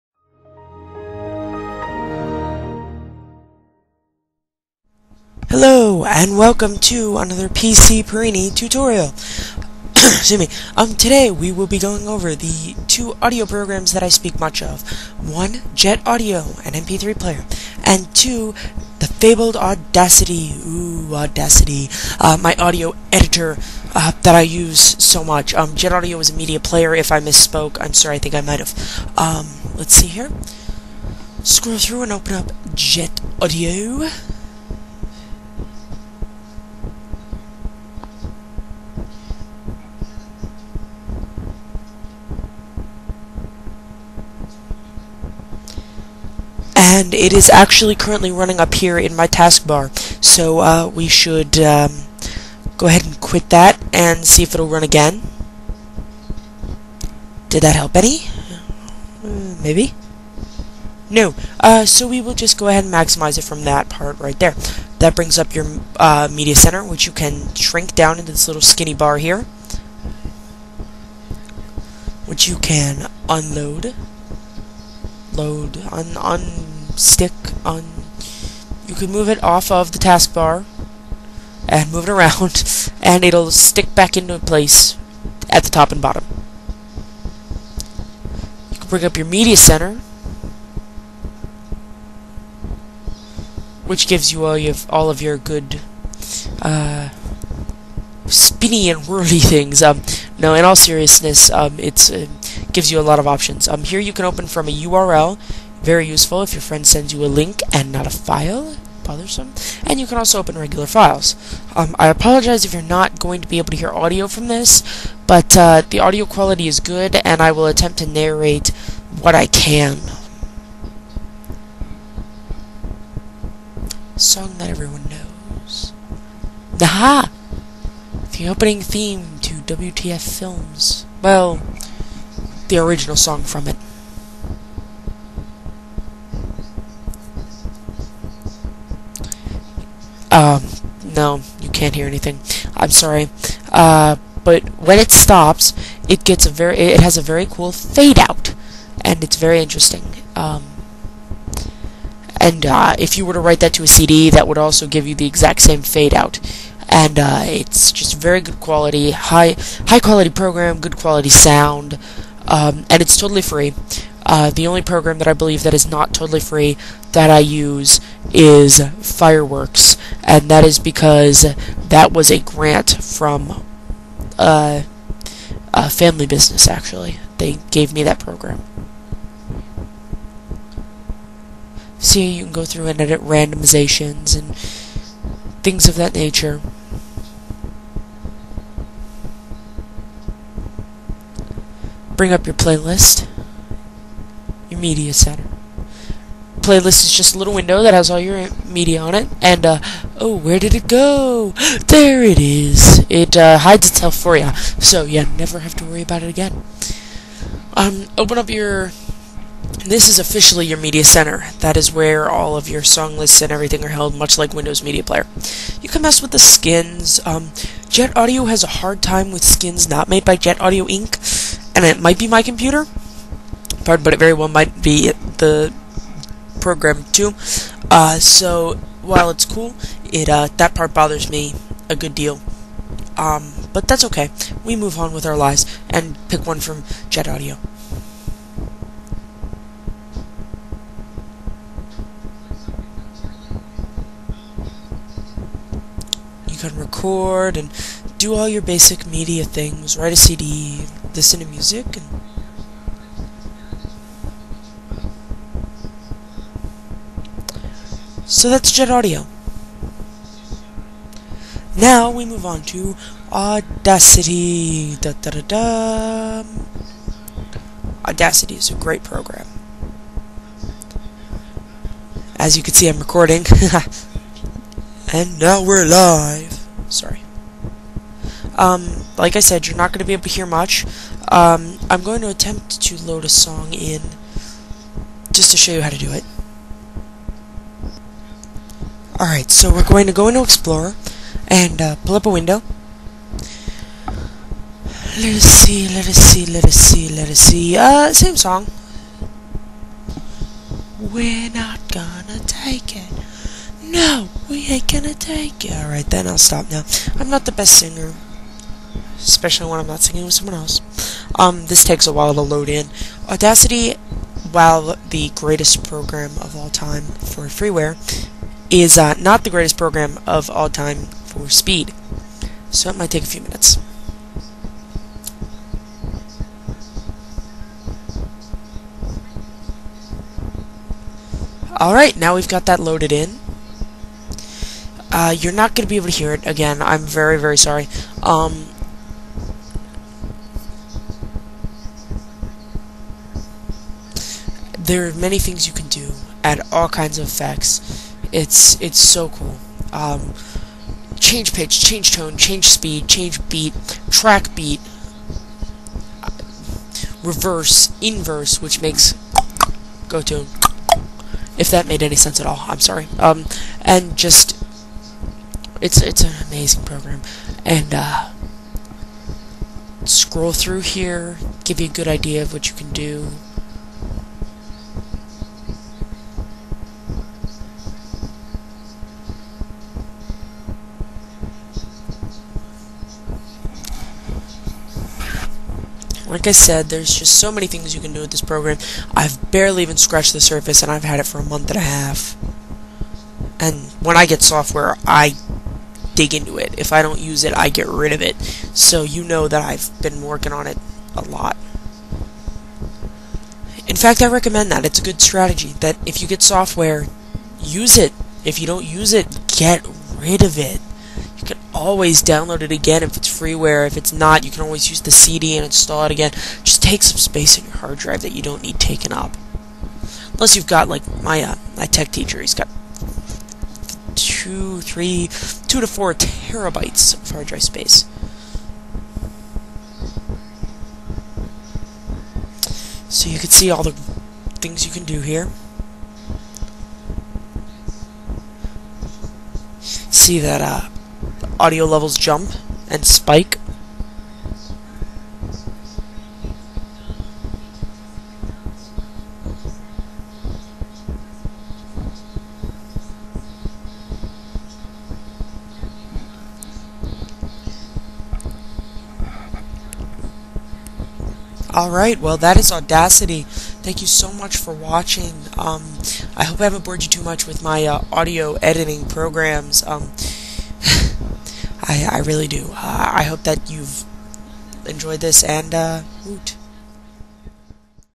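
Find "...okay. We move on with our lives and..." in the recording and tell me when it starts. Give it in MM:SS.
03:54.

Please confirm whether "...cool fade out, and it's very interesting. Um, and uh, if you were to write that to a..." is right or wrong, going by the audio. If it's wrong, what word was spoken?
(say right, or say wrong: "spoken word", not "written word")
right.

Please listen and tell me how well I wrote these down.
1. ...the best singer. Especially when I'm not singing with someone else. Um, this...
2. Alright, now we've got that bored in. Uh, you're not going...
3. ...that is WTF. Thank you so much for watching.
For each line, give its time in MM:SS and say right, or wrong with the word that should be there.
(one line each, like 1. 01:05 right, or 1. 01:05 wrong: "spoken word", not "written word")
1. 05:07 right
2. 05:31 wrong: "loaded", not "bored"
3. 07:42 wrong: "Audacity", not "WTF".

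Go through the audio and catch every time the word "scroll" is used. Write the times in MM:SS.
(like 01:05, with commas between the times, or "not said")
00:31, 06:10.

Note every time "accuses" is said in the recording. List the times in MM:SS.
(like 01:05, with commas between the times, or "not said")
not said.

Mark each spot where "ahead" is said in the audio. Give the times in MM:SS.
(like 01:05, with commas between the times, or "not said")
00:52, 01:02.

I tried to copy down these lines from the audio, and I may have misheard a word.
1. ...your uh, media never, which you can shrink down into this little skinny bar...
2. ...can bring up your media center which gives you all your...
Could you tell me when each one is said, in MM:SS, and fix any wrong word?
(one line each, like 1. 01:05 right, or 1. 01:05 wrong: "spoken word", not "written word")
1. 01:05 wrong: "center", not "never"
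2. 01:28 right.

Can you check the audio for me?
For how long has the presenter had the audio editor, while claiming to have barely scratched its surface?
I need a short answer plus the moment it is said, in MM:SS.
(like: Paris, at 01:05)
a month and a half, at 06:31.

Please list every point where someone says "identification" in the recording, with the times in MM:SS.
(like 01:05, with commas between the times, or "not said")
not said.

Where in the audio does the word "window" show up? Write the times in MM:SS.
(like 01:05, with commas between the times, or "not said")
03:17, 03:34, 04:52.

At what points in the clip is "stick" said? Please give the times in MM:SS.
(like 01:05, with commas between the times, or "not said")
01:16, 01:23.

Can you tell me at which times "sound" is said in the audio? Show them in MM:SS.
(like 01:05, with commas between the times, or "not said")
02:41.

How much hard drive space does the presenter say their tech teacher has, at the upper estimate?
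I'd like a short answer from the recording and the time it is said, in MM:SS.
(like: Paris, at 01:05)
4 terabytes, at 07:05.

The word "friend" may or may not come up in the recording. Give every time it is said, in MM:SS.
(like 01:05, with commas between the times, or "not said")
01:46.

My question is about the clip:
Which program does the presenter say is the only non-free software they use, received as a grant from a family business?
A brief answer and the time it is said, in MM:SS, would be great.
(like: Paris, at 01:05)
Fireworks, at 02:49.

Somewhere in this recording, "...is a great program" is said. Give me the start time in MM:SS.
04:28.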